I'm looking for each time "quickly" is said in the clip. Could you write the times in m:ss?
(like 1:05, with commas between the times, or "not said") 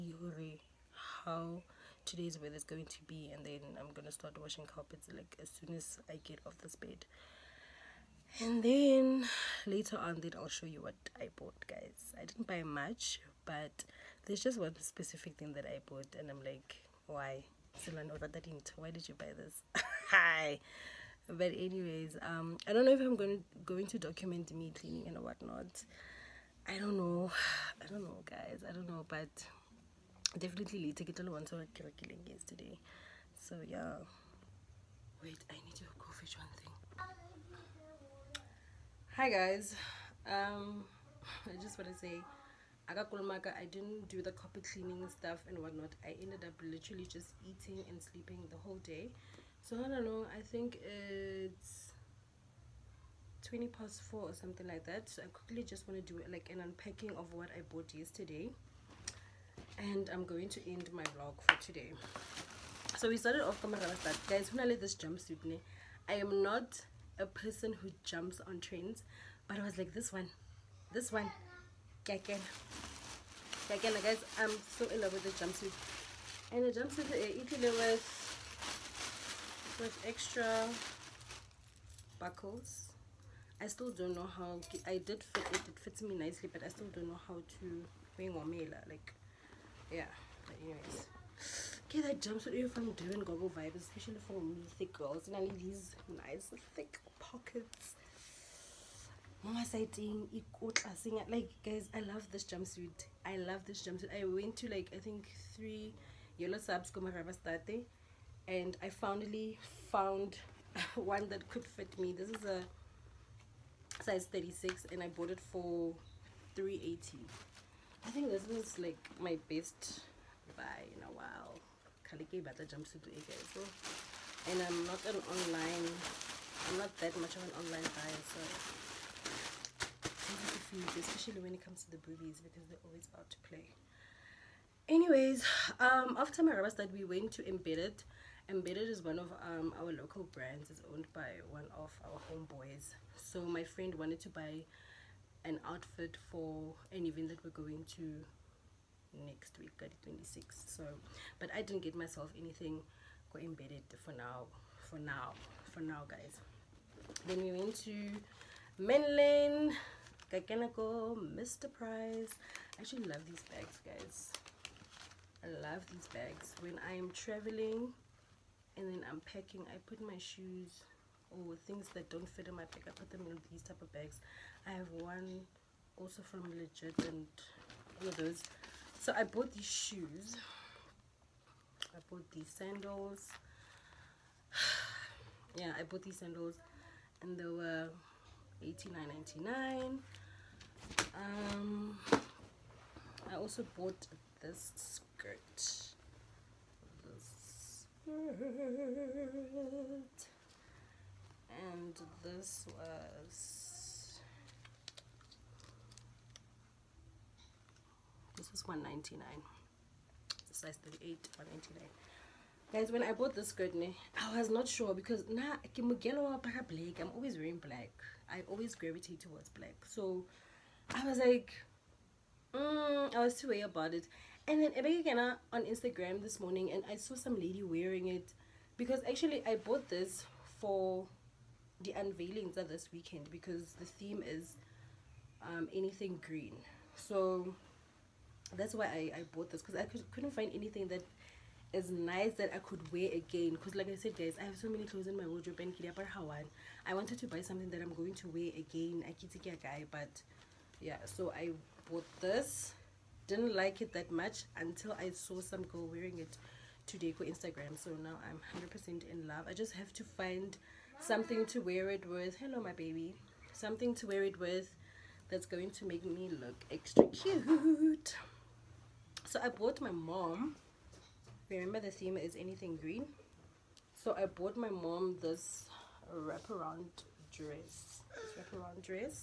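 0:55.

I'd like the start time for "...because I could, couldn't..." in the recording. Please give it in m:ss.
3:59.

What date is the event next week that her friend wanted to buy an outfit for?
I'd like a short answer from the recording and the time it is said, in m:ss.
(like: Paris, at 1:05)
26, at 2:30.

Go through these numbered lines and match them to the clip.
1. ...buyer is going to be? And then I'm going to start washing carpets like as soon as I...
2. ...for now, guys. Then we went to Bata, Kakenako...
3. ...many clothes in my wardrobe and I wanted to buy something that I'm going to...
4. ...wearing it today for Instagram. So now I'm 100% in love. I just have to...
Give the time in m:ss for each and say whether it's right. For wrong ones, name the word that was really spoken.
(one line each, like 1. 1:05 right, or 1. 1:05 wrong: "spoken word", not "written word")
1. 0:02 wrong: "weather", not "buyer"
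2. 2:35 wrong: "Menlyn", not "Bata"
3. 4:04 right
4. 4:15 right.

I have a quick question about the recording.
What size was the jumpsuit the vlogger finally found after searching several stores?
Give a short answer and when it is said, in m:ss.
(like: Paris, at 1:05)
36, at 1:54.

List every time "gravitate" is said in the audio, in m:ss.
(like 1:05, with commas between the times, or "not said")
3:38.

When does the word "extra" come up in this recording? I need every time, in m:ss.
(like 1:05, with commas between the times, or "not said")
1:20, 4:26.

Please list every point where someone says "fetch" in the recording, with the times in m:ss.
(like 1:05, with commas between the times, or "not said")
0:36.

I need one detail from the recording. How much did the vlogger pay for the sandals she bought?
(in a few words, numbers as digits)
89.99.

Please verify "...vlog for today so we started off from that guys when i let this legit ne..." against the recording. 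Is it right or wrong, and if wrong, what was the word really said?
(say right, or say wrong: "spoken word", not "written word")
wrong: "jumpsuit", not "legit".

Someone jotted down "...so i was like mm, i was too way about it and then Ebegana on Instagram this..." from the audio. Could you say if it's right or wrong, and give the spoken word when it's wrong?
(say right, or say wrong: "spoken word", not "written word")
right.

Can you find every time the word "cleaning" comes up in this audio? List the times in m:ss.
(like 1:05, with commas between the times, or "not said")
0:24, 0:44.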